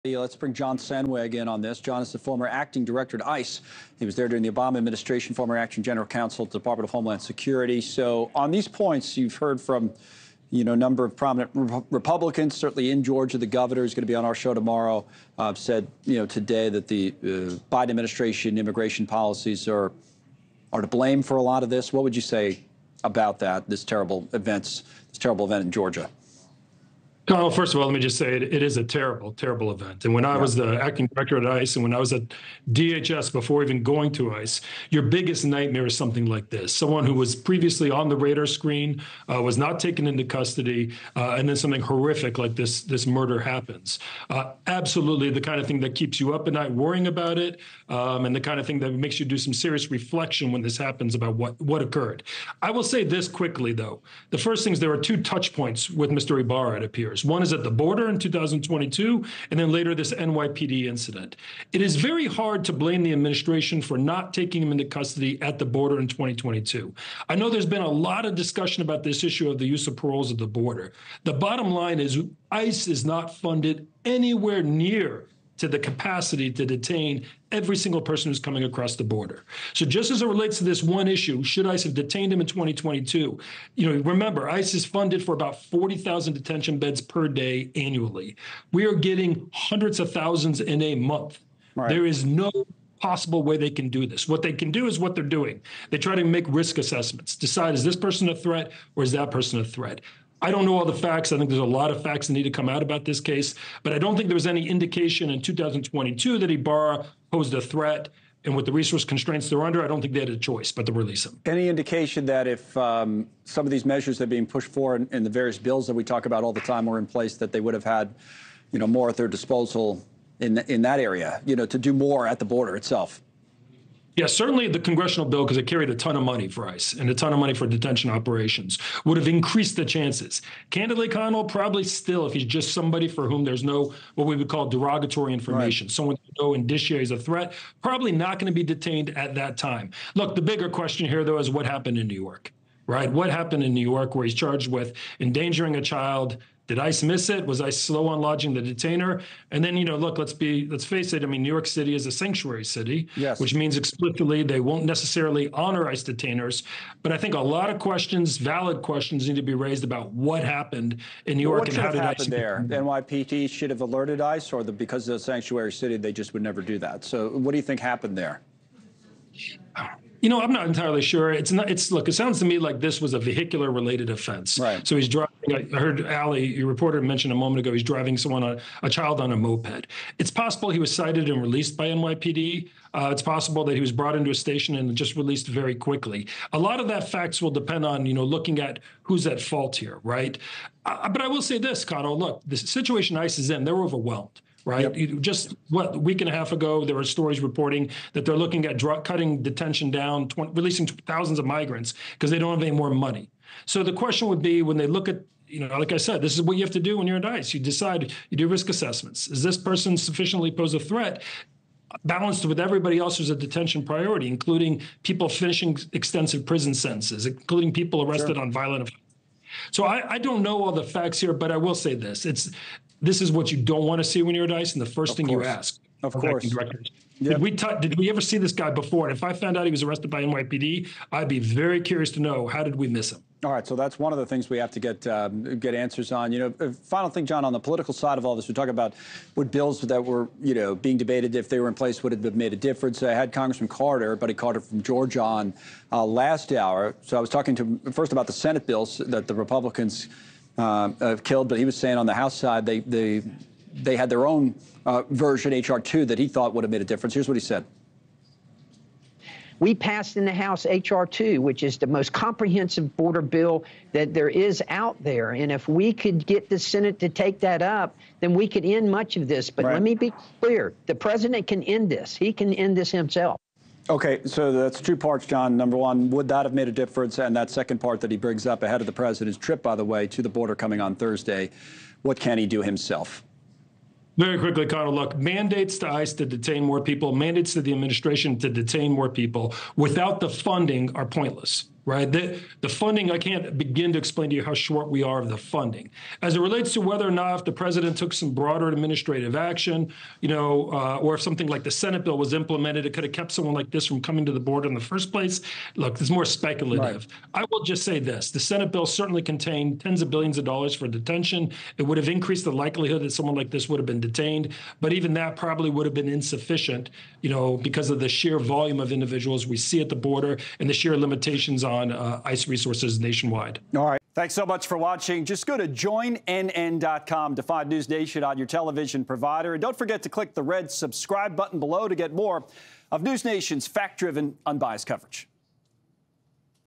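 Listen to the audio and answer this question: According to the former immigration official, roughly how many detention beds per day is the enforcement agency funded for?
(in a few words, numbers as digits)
40,000.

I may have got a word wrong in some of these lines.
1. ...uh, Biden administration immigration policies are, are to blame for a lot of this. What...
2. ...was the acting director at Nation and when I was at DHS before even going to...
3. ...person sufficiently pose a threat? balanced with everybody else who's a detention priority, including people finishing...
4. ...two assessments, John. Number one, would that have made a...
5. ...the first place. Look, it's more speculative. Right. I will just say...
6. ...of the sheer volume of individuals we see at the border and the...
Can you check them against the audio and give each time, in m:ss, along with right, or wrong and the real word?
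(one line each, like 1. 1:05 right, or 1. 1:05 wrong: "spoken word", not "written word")
1. 0:17 right
2. 0:30 wrong: "ICE", not "Nation"
3. 3:29 right
4. 4:34 wrong: "parts", not "assessments"
5. 5:04 right
6. 5:17 right.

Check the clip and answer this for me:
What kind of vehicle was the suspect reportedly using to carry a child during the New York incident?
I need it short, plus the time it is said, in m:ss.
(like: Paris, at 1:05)
Moped, at 2:59.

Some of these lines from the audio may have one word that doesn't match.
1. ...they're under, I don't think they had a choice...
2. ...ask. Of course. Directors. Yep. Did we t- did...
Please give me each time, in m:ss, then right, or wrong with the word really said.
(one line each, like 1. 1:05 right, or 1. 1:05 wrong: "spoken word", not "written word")
1. 1:49 right
2. 3:45 right.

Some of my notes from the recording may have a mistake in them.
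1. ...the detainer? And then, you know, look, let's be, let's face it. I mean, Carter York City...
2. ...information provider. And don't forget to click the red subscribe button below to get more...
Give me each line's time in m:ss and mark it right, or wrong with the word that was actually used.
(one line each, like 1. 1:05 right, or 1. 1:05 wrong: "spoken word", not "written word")
1. 2:28 wrong: "New", not "Carter"
2. 5:28 wrong: "television", not "information".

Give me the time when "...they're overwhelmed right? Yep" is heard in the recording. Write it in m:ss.
3:13.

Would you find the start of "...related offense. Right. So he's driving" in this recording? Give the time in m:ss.
2:53.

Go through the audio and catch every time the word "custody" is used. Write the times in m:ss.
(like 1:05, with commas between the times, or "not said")
0:40, 1:04.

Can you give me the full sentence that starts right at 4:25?
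And if we could get the Senate to take that up, then we could end much of this.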